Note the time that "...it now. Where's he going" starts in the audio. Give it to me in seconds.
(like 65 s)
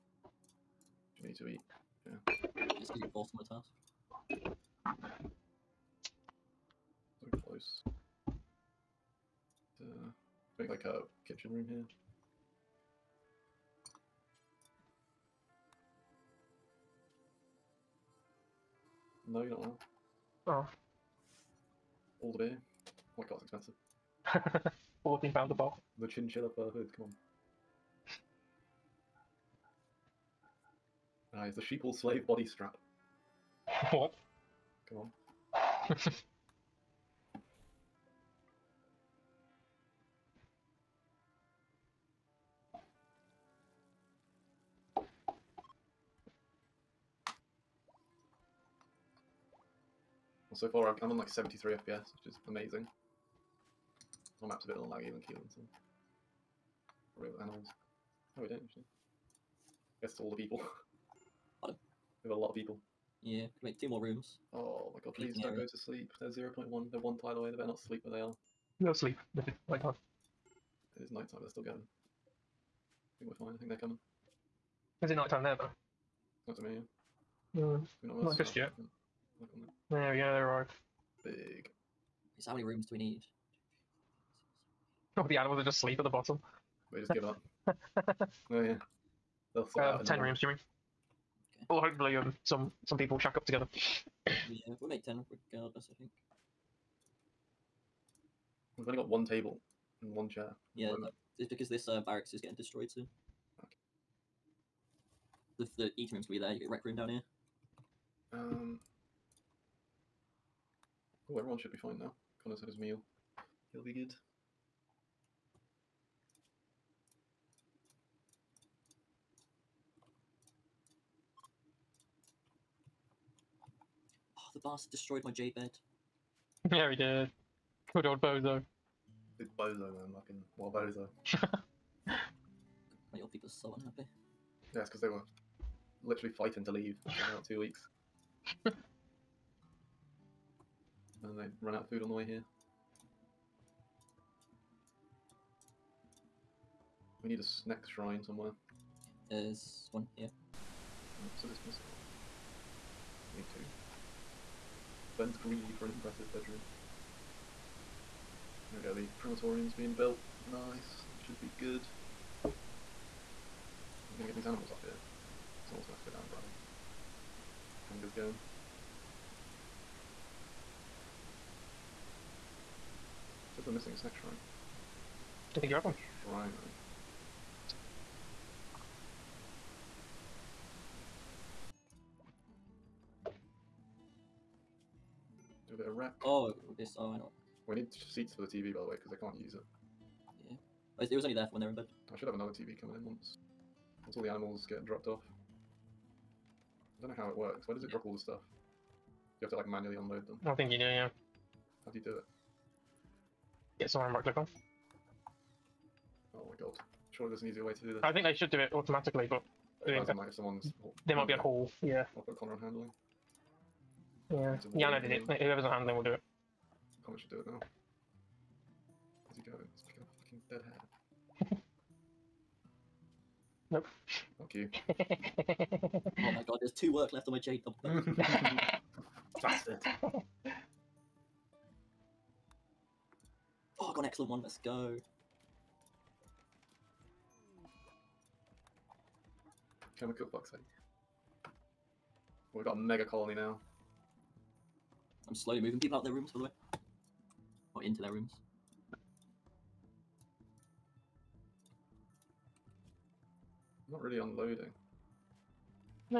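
217 s.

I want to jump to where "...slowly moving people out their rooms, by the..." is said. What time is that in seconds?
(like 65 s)
245 s.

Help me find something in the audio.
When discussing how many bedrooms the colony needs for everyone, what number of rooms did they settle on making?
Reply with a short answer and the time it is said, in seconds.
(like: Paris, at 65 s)
10, at 90 s.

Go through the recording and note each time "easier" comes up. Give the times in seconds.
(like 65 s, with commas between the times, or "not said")
207 s.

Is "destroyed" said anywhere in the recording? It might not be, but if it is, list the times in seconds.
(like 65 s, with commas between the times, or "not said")
102 s, 124 s.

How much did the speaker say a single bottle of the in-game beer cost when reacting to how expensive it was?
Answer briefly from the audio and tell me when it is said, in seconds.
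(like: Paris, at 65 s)
£14, at 25 s.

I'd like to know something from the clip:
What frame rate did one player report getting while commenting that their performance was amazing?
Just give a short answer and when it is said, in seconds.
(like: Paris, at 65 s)
73 FPS, at 51 s.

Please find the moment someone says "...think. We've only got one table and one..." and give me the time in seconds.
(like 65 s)
95 s.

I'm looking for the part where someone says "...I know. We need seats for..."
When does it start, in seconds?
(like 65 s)
187 s.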